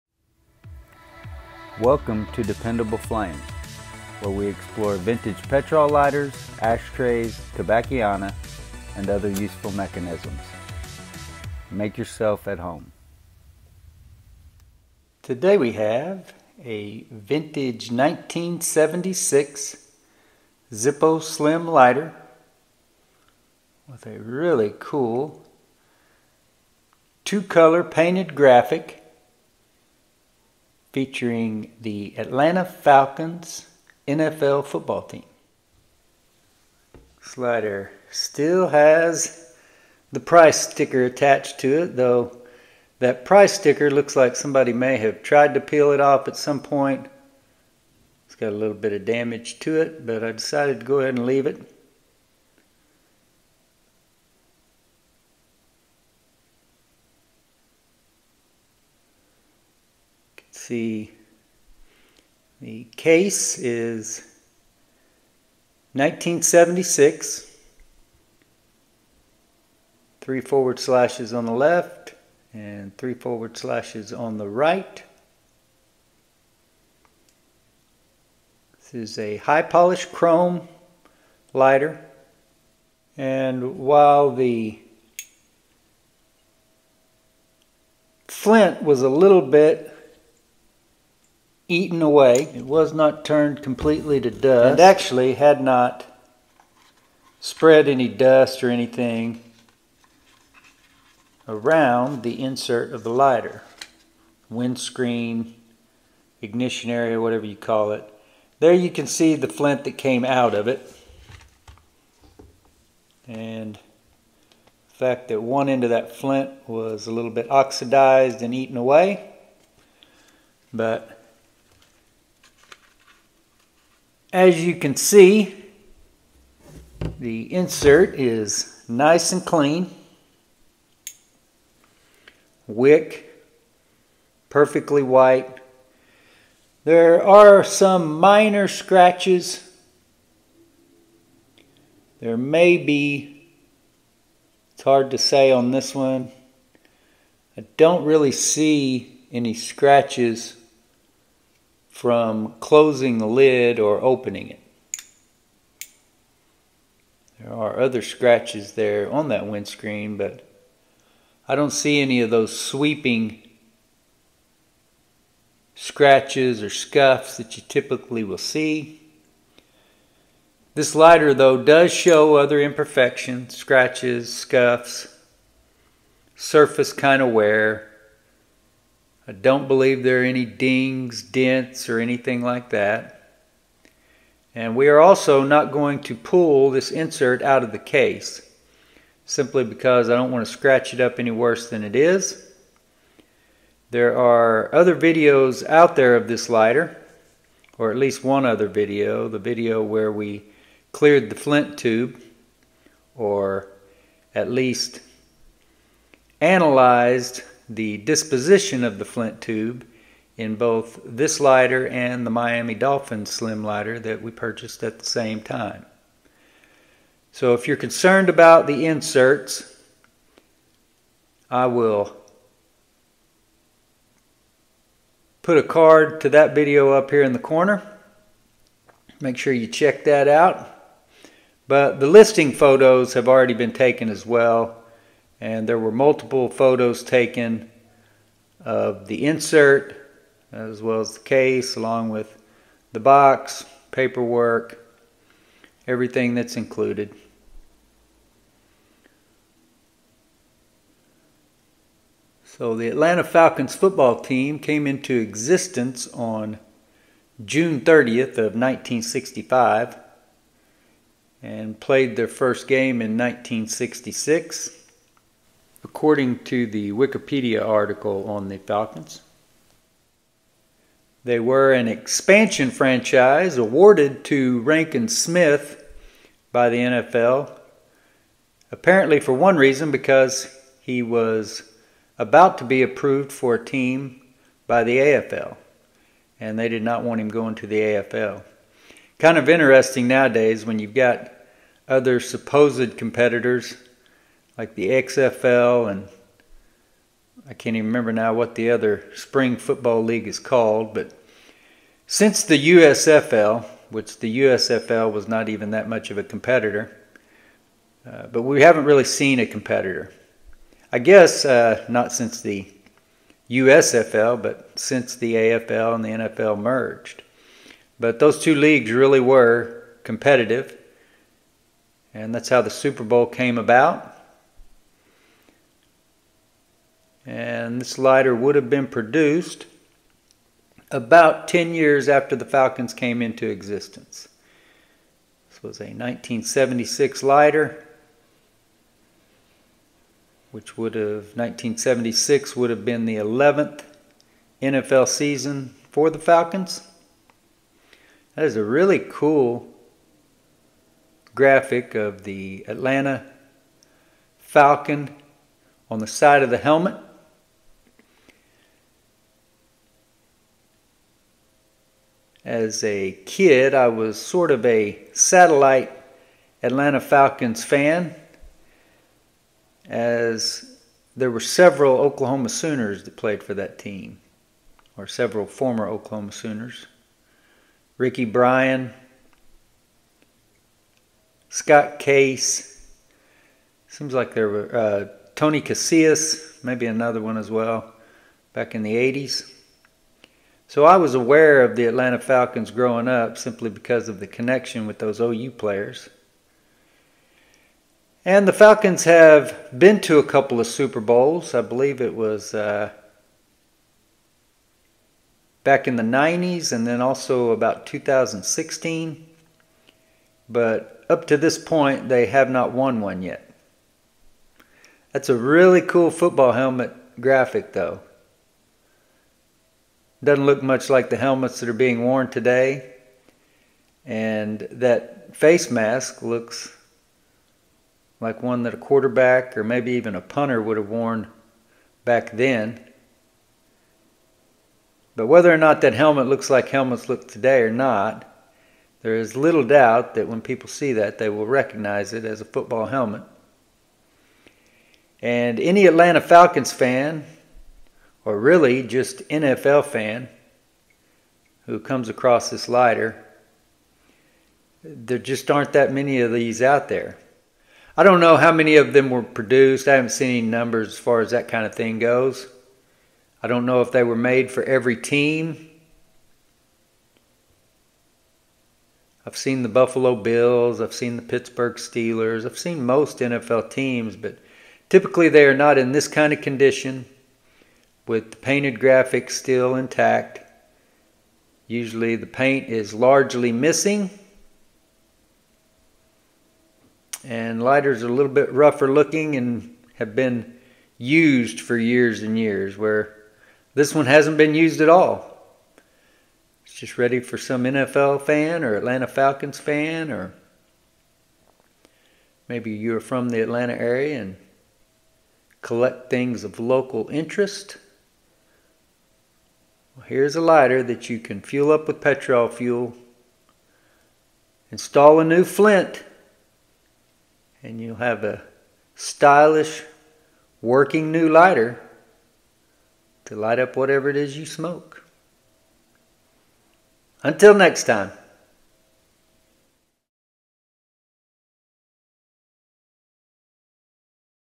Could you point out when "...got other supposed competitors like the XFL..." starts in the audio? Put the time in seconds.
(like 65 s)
290 s.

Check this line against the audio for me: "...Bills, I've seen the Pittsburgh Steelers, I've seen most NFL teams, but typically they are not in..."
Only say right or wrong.
right.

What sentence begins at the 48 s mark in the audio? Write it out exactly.
It's got a little bit of damage to it, but I decided to go ahead and leave it.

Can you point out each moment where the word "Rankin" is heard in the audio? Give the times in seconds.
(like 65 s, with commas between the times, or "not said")
274 s.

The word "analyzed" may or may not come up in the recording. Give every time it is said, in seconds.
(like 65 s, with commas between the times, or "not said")
206 s.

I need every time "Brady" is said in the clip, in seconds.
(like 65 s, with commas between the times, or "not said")
not said.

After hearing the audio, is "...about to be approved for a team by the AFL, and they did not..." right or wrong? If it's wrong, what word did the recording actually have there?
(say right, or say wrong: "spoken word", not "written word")
right.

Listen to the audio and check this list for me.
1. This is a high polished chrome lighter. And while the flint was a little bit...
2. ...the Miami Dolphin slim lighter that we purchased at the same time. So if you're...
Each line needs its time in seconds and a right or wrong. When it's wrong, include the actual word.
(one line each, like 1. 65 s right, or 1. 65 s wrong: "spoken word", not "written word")
1. 78 s right
2. 212 s right.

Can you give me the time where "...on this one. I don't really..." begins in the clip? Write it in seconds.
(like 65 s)
145 s.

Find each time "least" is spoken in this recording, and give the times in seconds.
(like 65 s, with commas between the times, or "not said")
197 s, 204 s.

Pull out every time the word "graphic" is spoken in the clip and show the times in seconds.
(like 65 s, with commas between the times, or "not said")
28 s, 351 s, 417 s, 478 s.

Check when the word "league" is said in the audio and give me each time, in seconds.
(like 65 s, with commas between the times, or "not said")
300 s, 318 s.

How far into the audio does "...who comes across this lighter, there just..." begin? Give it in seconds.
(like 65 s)
451 s.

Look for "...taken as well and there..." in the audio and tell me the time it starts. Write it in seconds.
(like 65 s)
233 s.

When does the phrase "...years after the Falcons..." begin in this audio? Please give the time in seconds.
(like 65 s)
331 s.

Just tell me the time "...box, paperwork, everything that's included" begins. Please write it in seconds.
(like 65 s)
242 s.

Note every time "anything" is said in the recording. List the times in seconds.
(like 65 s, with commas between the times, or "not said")
98 s, 182 s.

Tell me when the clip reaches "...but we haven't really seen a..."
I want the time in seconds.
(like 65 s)
308 s.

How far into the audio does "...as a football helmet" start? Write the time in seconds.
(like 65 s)
442 s.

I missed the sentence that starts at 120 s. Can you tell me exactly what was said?
But As you can see, the insert is nice and clean.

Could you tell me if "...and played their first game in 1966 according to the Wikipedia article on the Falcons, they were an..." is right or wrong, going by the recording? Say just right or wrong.
right.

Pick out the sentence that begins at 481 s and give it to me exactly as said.
Usually the paint is largely missing.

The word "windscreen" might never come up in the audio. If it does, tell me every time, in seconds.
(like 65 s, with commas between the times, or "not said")
104 s, 159 s.